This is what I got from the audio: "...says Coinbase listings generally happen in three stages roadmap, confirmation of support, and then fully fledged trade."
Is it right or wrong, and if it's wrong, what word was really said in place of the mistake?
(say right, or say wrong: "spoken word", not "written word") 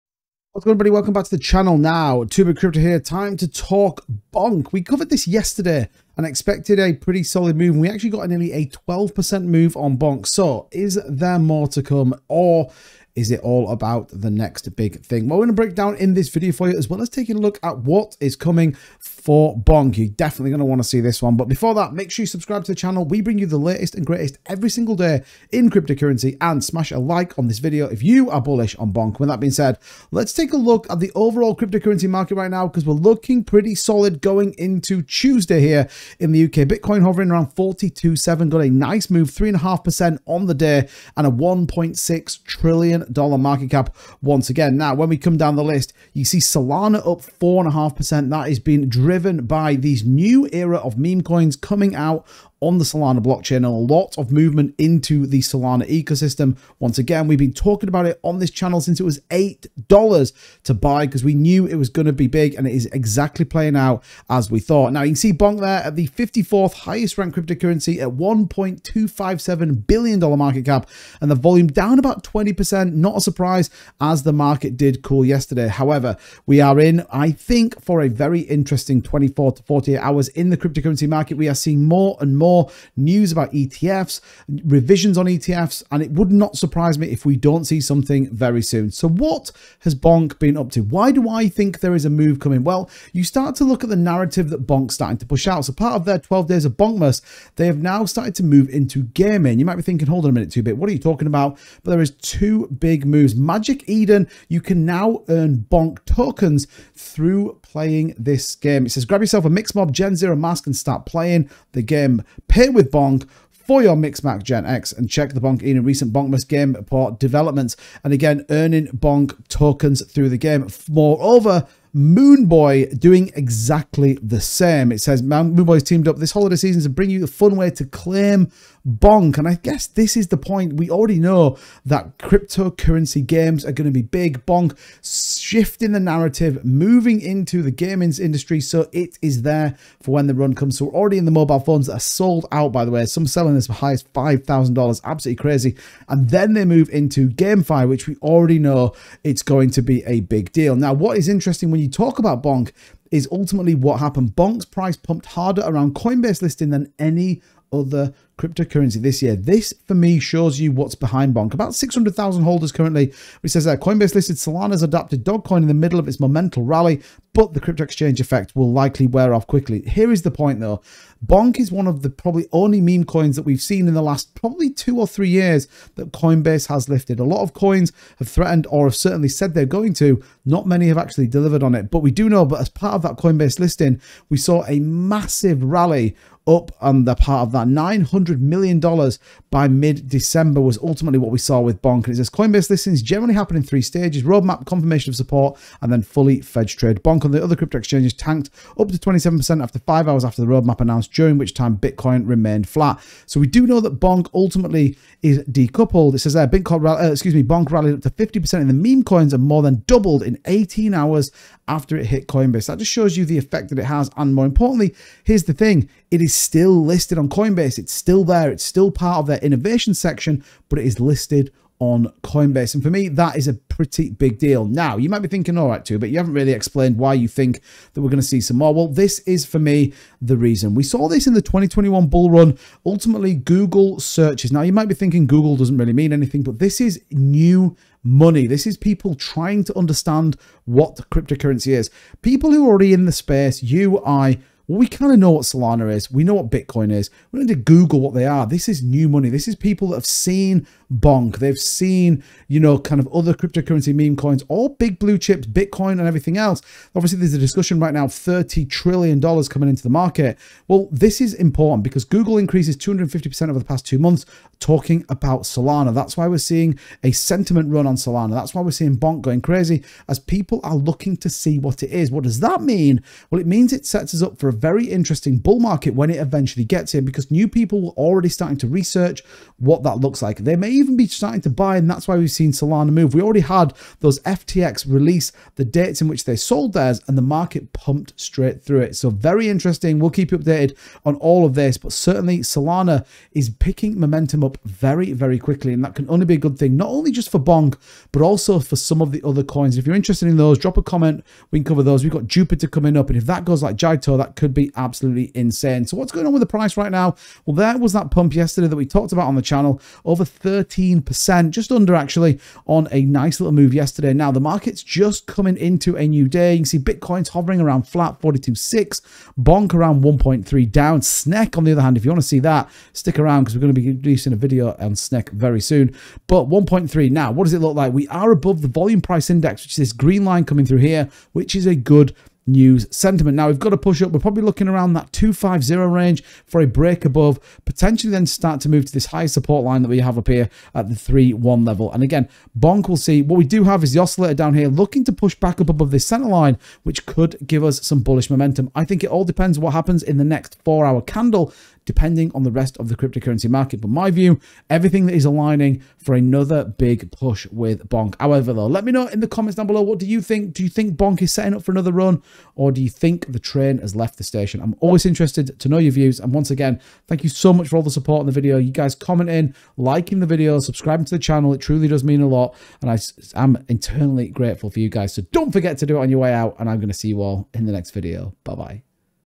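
right.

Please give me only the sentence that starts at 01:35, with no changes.
So part of their 12 days of Bonkmas, they have now started to move into gaming.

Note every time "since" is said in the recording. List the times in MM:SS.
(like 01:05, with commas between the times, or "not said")
00:58.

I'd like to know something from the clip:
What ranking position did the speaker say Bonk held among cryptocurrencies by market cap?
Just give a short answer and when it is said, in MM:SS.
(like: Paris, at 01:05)
54th, at 01:06.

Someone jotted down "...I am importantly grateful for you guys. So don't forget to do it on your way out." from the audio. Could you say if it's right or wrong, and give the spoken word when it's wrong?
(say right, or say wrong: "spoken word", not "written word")
wrong: "internally", not "importantly".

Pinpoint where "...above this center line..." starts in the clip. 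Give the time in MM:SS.
05:45.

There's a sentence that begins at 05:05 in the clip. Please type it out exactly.
So what's going on with the price right now?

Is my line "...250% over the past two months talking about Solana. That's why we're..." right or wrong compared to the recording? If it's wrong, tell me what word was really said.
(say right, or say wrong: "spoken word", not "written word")
right.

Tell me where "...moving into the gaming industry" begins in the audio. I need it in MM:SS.
02:16.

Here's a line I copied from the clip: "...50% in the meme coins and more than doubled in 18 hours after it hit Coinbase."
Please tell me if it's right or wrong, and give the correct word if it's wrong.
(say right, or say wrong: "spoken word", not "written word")
right.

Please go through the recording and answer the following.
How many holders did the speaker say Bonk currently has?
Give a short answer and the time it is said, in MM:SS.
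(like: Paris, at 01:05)
600,000, at 02:41.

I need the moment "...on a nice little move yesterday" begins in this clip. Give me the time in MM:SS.
05:12.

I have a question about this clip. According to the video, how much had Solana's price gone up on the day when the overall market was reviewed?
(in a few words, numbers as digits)
4.5%.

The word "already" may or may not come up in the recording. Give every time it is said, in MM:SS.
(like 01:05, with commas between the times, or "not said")
02:10, 02:20, 02:28, 04:02, 04:37, 04:43.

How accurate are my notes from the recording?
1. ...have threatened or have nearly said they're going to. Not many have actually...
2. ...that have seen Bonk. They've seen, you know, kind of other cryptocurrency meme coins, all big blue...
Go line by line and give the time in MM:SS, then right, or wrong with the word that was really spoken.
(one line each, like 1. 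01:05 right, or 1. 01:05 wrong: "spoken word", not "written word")
1. 02:58 wrong: "certainly", not "nearly"
2. 04:09 right.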